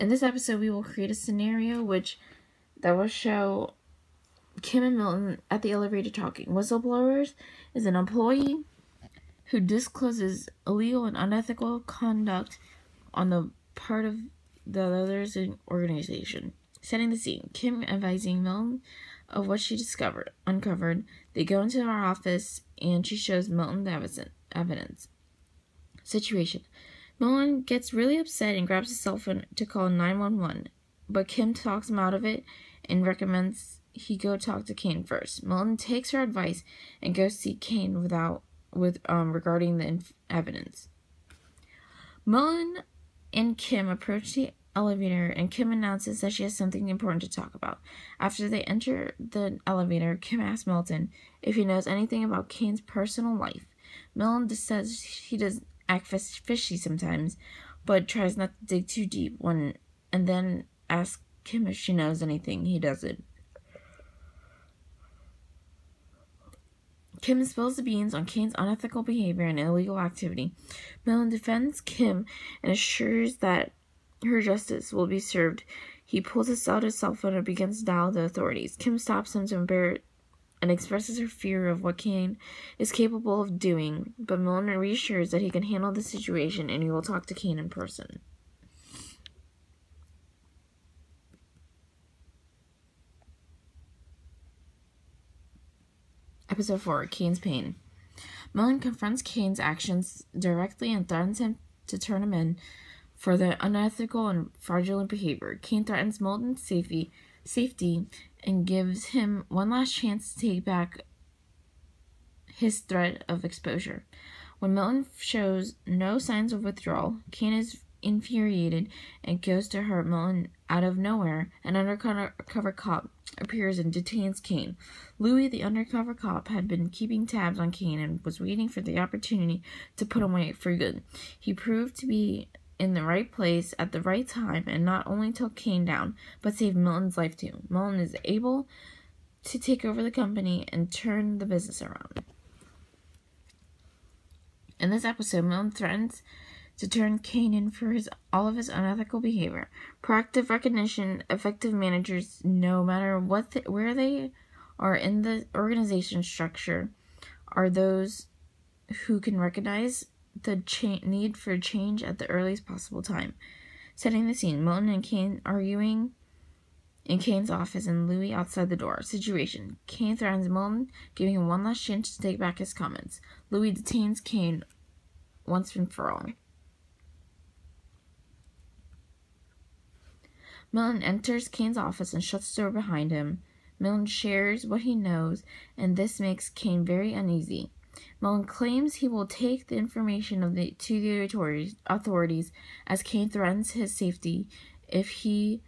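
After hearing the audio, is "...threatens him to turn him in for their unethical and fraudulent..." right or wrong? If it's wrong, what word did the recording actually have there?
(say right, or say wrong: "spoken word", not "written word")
right.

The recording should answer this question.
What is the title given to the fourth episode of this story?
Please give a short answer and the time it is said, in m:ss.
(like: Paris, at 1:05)
Kane's Pain, at 1:37.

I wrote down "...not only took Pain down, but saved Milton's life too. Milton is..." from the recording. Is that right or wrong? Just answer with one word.
wrong.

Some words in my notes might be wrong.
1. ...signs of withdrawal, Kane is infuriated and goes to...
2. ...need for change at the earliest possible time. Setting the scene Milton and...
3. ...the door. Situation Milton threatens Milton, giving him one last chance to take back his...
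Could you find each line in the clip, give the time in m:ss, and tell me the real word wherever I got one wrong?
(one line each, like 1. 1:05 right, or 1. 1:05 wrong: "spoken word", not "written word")
1. 1:56 right
2. 2:41 right
3. 2:48 wrong: "Kane", not "Milton".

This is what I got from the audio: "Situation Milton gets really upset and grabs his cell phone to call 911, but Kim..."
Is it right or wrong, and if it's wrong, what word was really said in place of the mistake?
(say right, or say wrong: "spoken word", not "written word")
right.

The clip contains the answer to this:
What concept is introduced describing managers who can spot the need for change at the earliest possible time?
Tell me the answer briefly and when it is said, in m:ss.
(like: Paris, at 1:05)
Proactive recognition, at 2:30.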